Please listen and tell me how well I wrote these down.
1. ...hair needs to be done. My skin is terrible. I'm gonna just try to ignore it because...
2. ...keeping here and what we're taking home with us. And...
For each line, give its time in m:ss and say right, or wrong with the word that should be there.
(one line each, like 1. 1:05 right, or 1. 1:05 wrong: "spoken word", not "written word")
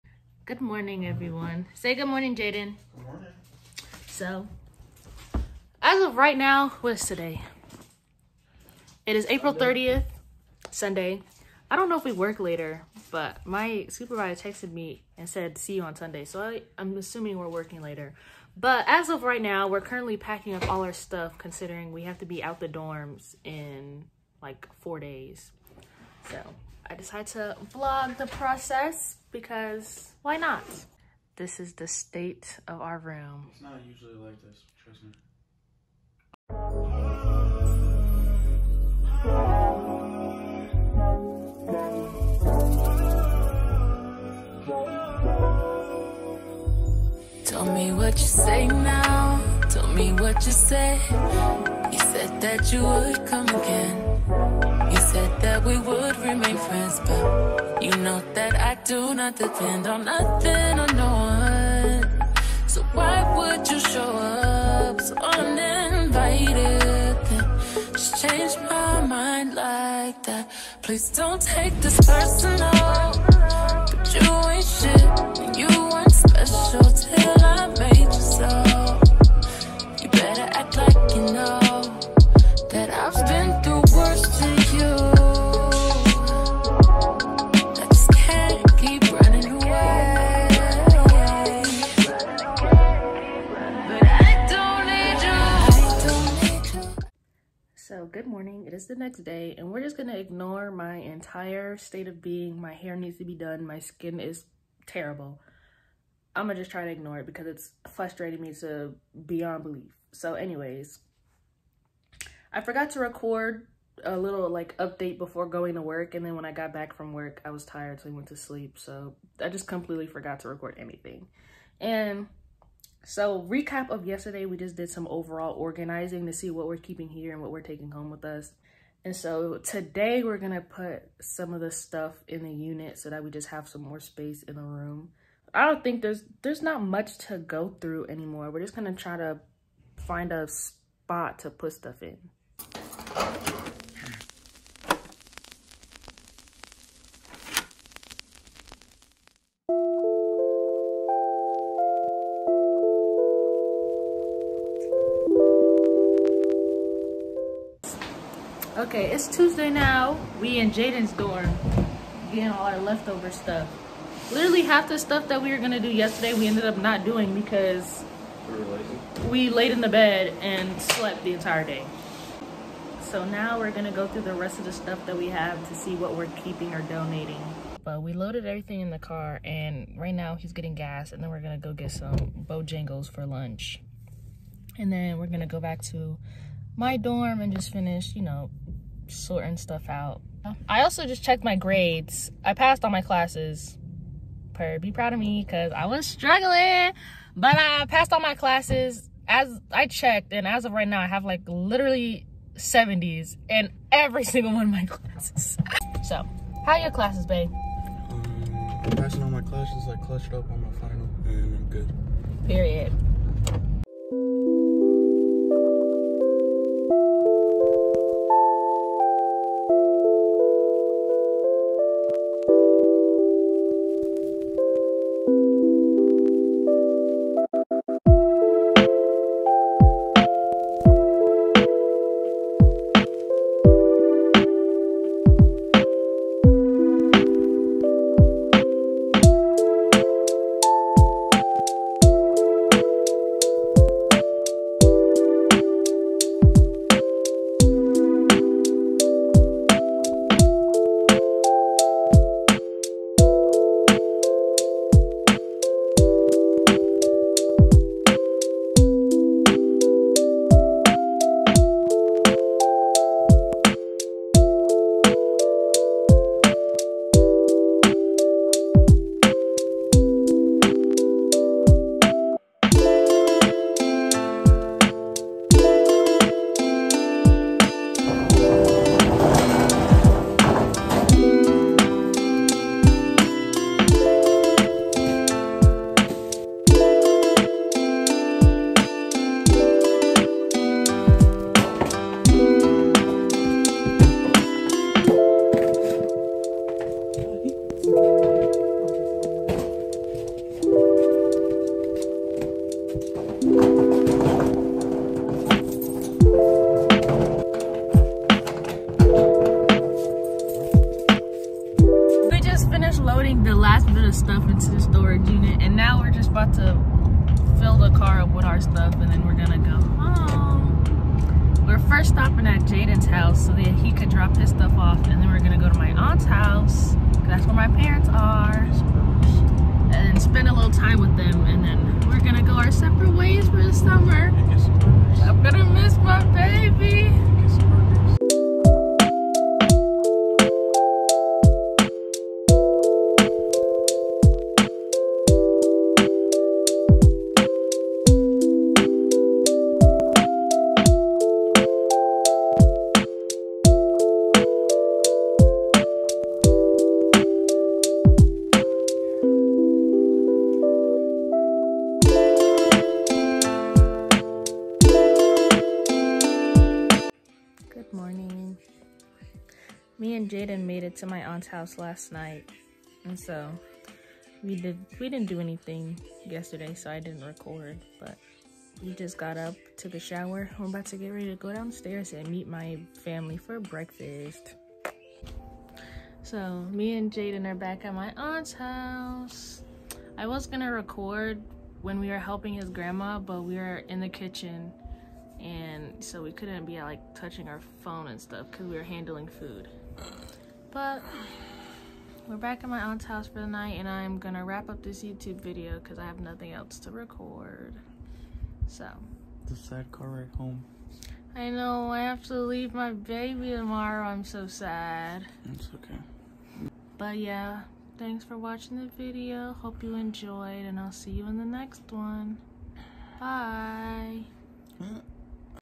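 1. 1:42 right
2. 2:06 right.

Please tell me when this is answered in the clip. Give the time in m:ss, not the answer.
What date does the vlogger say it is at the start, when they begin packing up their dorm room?
0:09.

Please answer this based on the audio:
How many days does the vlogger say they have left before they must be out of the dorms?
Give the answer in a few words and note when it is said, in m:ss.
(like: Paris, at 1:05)
4, at 0:24.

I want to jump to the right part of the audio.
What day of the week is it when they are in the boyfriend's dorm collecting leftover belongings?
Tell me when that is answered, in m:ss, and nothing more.
2:39.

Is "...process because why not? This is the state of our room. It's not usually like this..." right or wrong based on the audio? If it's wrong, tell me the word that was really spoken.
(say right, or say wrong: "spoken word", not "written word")
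right.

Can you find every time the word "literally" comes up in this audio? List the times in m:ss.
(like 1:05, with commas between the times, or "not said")
2:44, 3:21.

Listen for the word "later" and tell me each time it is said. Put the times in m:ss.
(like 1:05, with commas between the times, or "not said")
0:12, 0:17.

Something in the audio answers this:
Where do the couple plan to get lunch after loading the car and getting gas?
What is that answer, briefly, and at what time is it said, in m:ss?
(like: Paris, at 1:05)
Bojangles, at 3:02.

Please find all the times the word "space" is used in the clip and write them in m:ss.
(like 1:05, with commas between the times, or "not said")
2:13.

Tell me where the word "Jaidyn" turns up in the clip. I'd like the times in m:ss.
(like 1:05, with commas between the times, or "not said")
0:02, 2:40, 5:22, 6:10, 6:27.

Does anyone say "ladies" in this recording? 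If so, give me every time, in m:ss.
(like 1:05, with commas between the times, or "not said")
not said.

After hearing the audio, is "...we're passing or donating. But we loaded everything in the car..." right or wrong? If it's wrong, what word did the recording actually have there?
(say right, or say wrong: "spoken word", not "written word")
wrong: "keeping", not "passing".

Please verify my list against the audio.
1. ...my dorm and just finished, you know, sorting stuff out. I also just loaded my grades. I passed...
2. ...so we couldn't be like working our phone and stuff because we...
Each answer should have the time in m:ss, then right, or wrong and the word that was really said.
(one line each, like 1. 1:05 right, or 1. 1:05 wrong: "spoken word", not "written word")
1. 3:06 wrong: "checked", not "loaded"
2. 6:36 wrong: "touching", not "working".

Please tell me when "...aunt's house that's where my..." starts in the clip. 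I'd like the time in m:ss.
5:25.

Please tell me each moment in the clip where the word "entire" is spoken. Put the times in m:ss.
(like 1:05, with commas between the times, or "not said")
1:40, 2:51.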